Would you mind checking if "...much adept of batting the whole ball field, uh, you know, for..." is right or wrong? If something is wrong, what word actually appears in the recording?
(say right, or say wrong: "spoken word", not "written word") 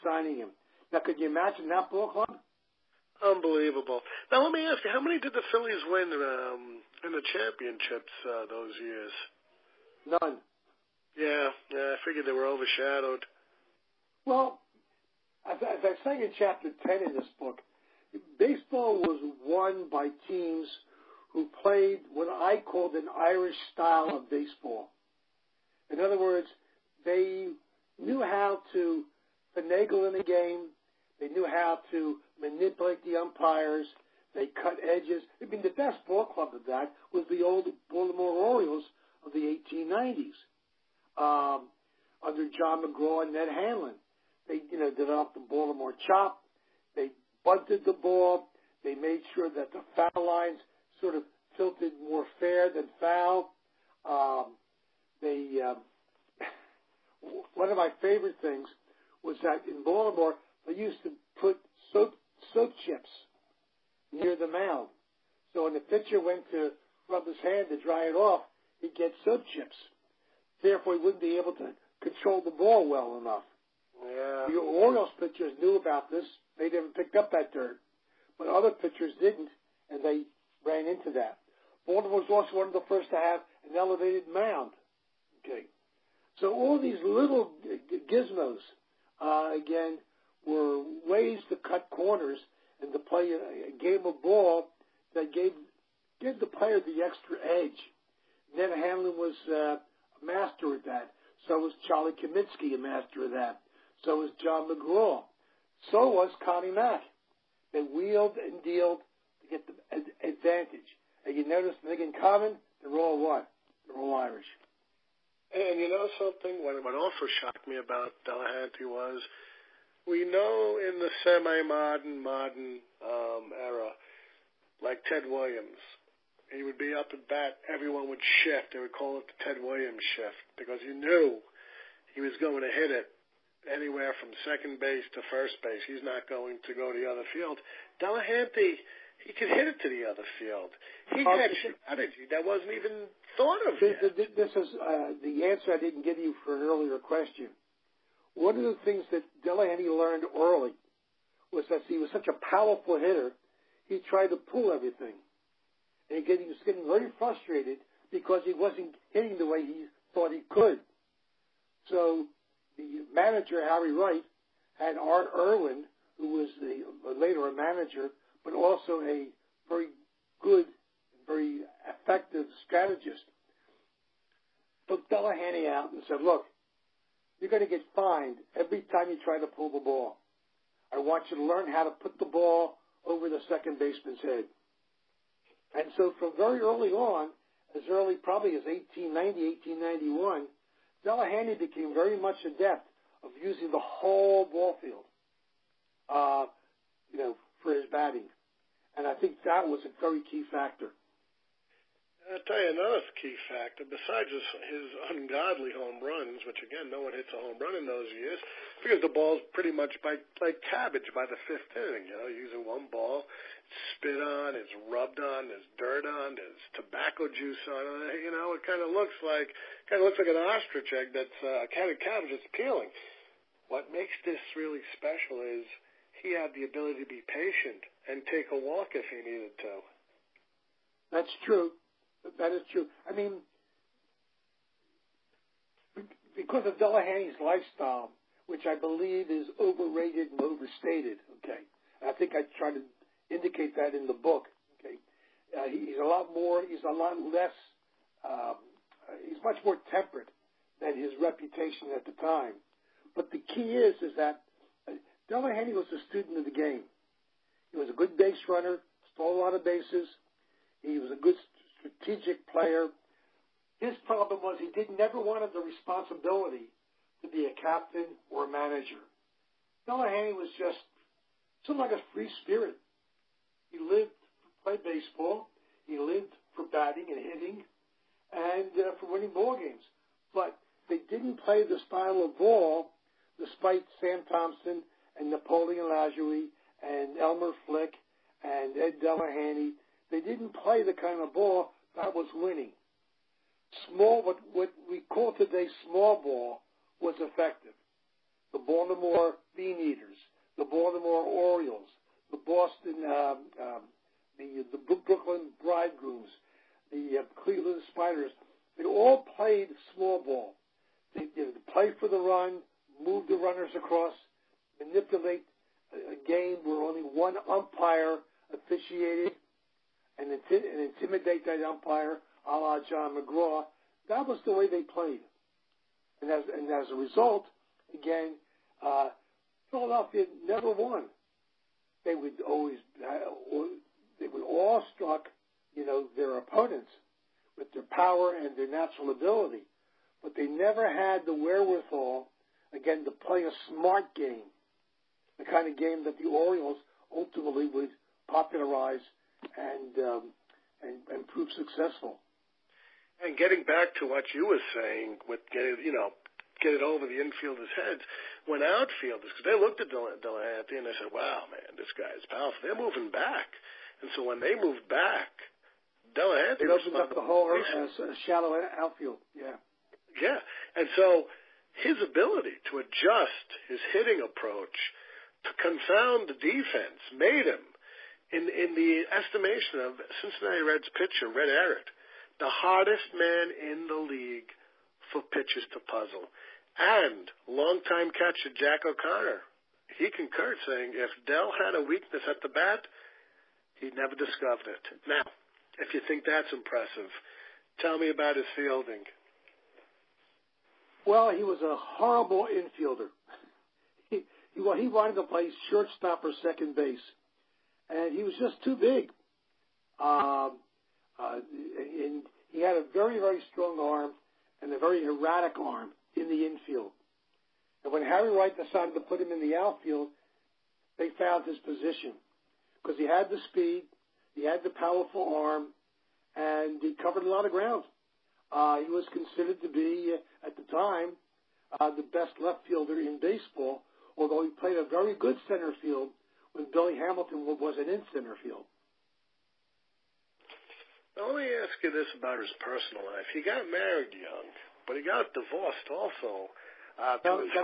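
wrong: "using", not "batting".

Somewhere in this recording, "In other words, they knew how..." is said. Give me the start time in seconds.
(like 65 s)
25 s.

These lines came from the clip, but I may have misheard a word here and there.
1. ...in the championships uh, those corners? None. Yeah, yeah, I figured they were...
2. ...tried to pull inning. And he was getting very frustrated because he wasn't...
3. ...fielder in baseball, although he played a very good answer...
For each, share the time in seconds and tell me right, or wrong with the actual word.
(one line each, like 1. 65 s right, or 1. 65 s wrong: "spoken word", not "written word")
1. 7 s wrong: "years", not "corners"
2. 154 s wrong: "everything", not "inning"
3. 432 s wrong: "center", not "answer".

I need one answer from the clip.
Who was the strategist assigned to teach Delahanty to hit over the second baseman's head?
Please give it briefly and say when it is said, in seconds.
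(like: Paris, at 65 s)
Art Irwin, at 164 s.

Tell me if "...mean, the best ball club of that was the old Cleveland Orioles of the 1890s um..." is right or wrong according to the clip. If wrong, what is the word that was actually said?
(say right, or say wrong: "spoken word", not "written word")
wrong: "Baltimore", not "Cleveland".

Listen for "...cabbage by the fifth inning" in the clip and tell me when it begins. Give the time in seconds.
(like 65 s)
210 s.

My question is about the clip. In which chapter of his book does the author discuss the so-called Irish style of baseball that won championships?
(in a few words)
Chapter 10.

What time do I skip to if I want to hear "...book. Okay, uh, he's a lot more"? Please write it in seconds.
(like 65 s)
244 s.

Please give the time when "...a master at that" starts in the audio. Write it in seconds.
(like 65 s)
99 s.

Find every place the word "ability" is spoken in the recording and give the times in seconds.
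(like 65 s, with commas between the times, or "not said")
226 s, 339 s, 372 s.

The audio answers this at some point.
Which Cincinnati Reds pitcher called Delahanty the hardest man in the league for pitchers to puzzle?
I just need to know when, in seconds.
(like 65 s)
381 s.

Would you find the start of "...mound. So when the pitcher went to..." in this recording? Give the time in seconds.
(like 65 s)
64 s.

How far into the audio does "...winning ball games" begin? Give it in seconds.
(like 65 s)
279 s.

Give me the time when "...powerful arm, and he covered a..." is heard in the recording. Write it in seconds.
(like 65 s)
424 s.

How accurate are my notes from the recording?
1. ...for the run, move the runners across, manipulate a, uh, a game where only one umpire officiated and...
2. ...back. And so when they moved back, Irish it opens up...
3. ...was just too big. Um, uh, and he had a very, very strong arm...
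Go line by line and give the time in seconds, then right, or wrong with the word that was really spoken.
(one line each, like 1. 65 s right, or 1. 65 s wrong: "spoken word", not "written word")
1. 311 s right
2. 363 s wrong: "Delahanty", not "Irish"
3. 408 s right.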